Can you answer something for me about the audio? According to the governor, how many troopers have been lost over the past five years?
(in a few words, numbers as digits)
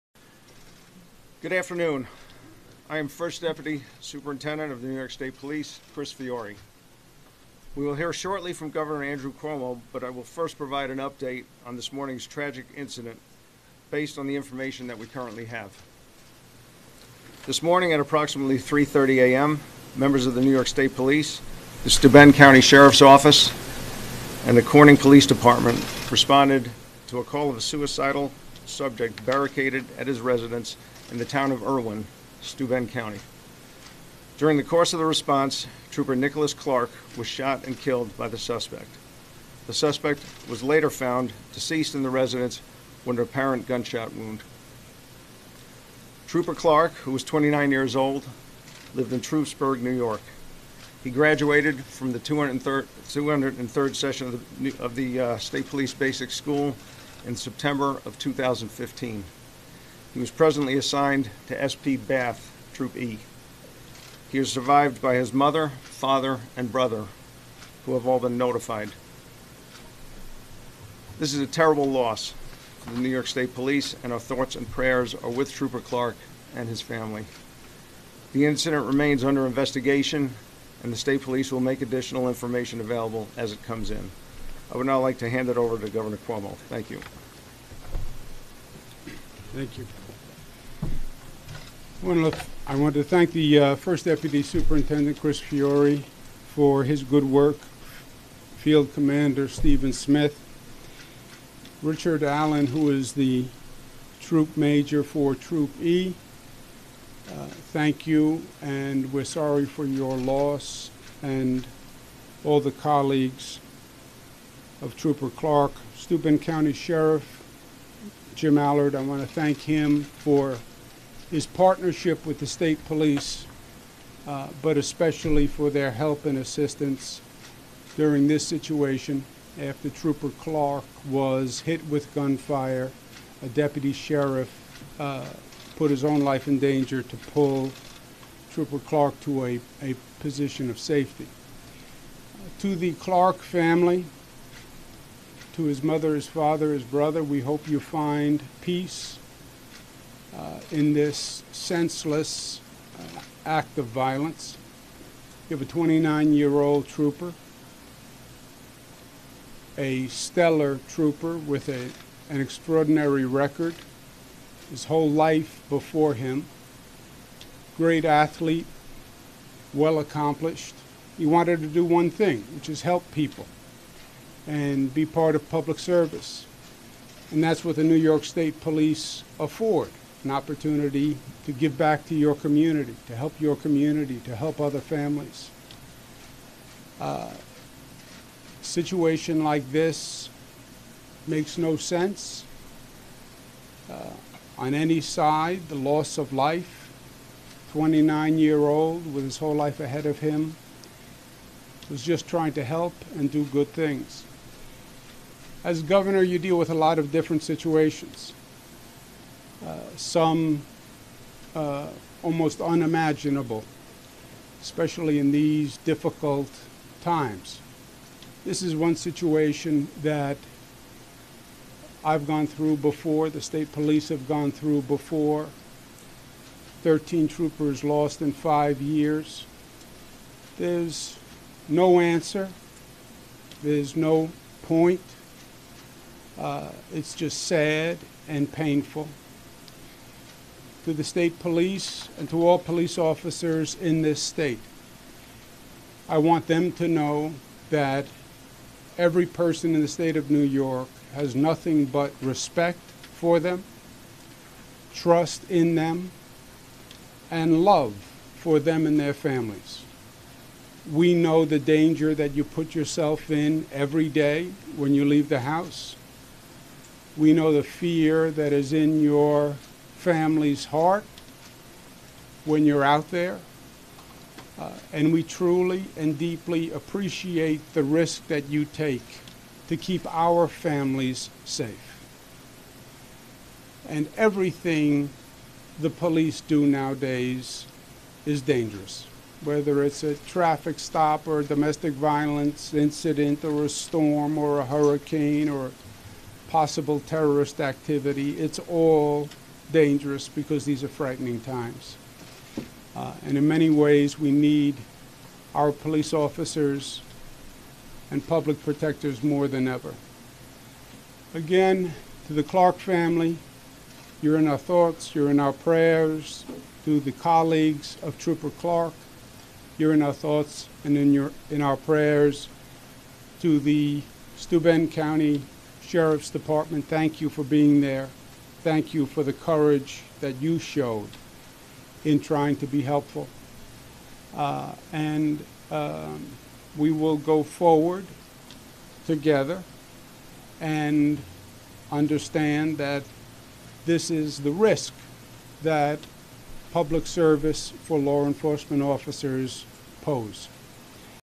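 13.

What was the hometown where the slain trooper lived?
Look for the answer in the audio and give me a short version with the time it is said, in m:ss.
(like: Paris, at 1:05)
Troupsburg, at 0:49.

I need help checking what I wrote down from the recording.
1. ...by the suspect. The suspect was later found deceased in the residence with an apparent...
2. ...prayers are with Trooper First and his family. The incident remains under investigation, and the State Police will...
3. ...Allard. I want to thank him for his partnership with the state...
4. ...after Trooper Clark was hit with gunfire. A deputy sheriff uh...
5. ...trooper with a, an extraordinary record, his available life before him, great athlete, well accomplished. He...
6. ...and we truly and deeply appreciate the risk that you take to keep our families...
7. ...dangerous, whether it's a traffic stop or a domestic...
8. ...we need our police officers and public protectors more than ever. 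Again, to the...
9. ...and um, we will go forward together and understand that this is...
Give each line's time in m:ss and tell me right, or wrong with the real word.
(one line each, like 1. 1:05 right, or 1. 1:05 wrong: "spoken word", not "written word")
1. 0:38 right
2. 1:14 wrong: "Clark", not "First"
3. 1:58 right
4. 2:09 right
5. 2:40 wrong: "whole", not "available"
6. 4:34 right
7. 4:48 right
8. 5:04 right
9. 5:34 right.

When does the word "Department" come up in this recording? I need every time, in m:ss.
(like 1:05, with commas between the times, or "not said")
0:25, 5:26.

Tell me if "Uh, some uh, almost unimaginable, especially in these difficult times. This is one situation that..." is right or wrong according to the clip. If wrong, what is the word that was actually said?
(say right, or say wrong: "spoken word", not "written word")
right.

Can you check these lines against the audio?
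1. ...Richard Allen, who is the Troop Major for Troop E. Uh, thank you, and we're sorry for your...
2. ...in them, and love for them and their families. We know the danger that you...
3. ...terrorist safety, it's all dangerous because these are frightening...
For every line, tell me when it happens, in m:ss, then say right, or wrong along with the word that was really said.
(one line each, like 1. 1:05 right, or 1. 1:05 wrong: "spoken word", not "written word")
1. 1:41 right
2. 4:15 right
3. 4:57 wrong: "activity", not "safety".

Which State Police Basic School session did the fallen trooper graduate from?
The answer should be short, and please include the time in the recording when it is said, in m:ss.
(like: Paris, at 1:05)
203rd, at 0:53.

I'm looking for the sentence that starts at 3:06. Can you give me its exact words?
Uh, situation like this makes no sense.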